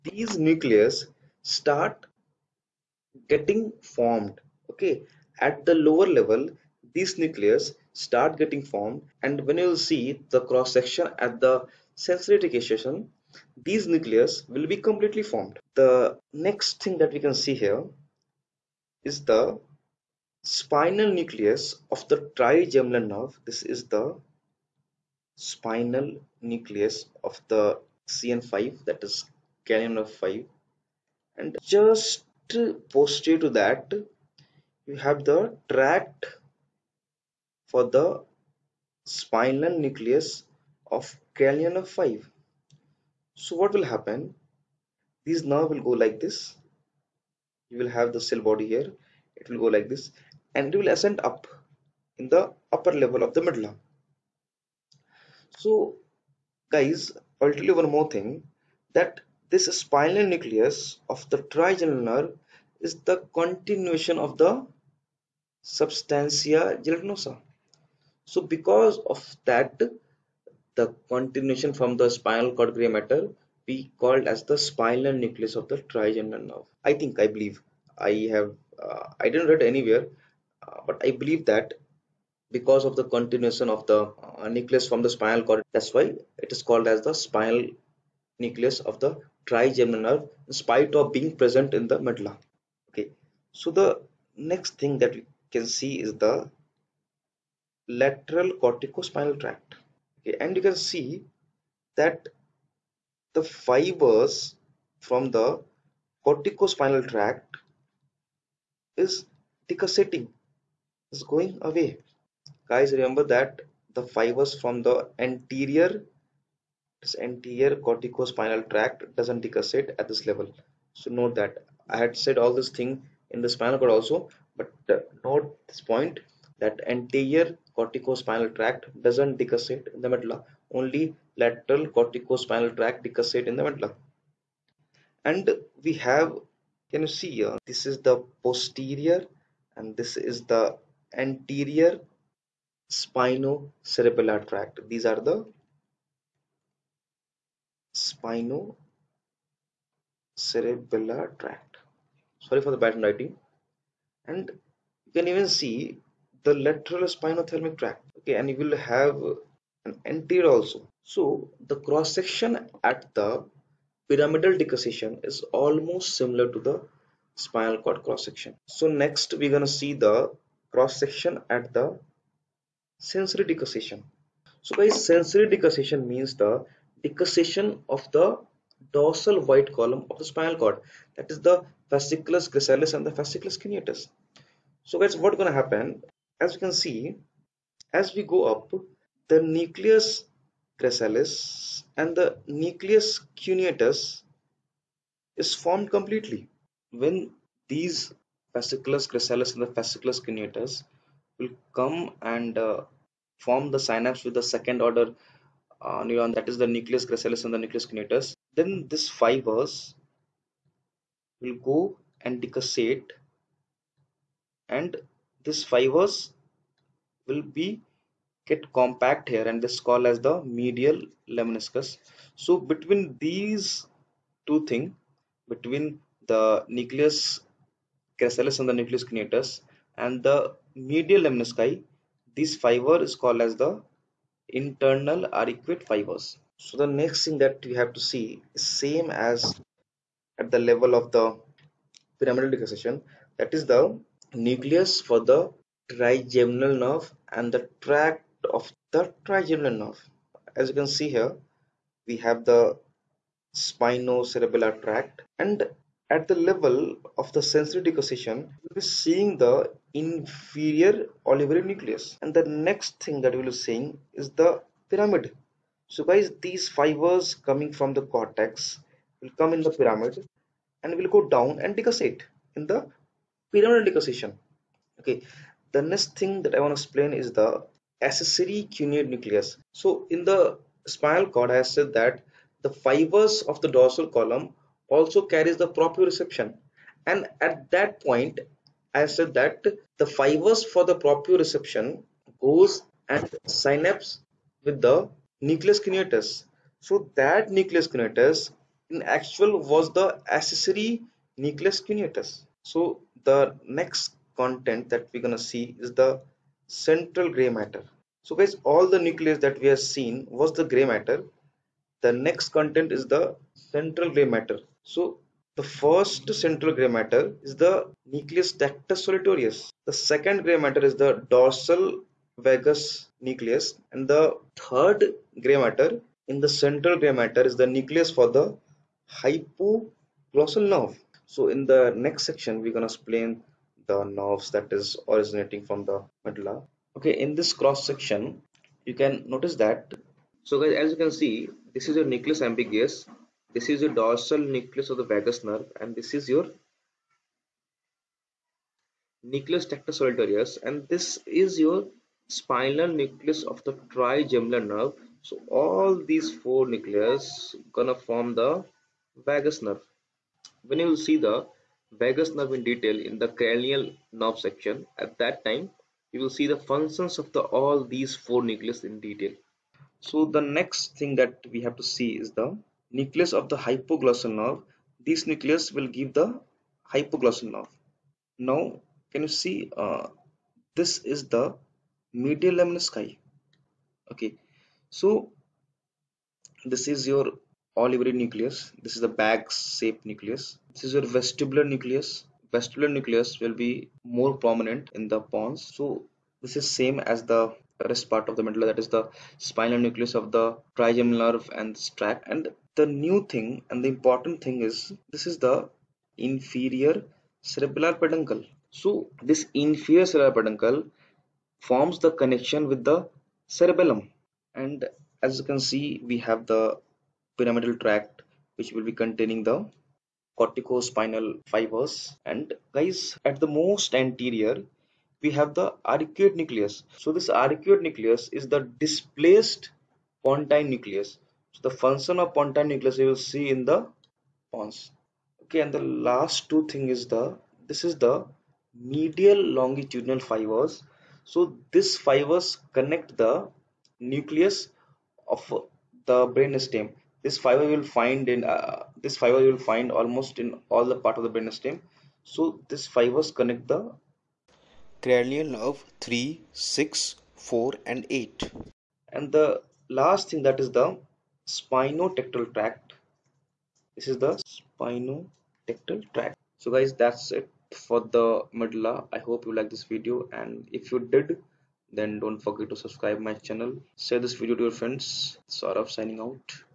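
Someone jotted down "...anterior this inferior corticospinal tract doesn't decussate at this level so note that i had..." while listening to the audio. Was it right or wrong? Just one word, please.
wrong.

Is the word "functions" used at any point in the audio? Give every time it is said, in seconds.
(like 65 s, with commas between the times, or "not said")
366 s, 431 s.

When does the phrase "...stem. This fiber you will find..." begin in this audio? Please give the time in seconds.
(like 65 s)
446 s.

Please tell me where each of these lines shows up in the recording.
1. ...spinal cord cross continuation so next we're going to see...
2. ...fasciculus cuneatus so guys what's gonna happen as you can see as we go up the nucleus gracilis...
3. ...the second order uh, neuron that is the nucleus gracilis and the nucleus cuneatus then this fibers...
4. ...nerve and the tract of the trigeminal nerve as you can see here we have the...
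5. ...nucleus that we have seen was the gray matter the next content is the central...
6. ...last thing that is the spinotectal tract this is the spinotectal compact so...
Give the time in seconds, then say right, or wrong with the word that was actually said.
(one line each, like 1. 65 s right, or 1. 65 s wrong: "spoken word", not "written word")
1. 167 s wrong: "section", not "continuation"
2. 183 s right
3. 204 s right
4. 246 s right
5. 309 s right
6. 459 s wrong: "tract", not "compact".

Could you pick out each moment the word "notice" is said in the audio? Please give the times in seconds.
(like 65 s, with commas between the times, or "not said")
339 s.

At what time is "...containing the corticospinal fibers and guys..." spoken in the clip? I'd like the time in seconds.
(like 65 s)
419 s.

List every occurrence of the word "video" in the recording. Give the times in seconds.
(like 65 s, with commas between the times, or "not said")
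469 s, 474 s.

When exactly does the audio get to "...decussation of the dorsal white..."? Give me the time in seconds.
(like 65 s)
177 s.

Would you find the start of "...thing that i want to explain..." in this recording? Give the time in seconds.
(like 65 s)
276 s.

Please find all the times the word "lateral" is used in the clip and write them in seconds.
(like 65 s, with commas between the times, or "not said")
98 s, 131 s, 156 s.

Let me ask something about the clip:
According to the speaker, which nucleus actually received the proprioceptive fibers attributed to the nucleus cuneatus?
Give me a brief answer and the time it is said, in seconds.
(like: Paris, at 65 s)
Accessory nucleus cuneatus, at 300 s.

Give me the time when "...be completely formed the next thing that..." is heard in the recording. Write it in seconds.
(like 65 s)
14 s.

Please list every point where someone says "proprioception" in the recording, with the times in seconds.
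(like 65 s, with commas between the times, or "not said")
285 s, 291 s.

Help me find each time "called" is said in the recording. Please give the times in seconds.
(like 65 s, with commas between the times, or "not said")
74 s, 86 s, 219 s, 233 s.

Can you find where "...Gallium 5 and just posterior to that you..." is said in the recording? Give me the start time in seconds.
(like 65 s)
29 s.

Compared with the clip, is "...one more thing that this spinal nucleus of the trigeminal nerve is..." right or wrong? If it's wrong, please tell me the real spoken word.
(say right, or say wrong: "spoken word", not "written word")
right.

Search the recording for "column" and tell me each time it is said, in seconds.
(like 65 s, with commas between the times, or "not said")
179 s, 284 s.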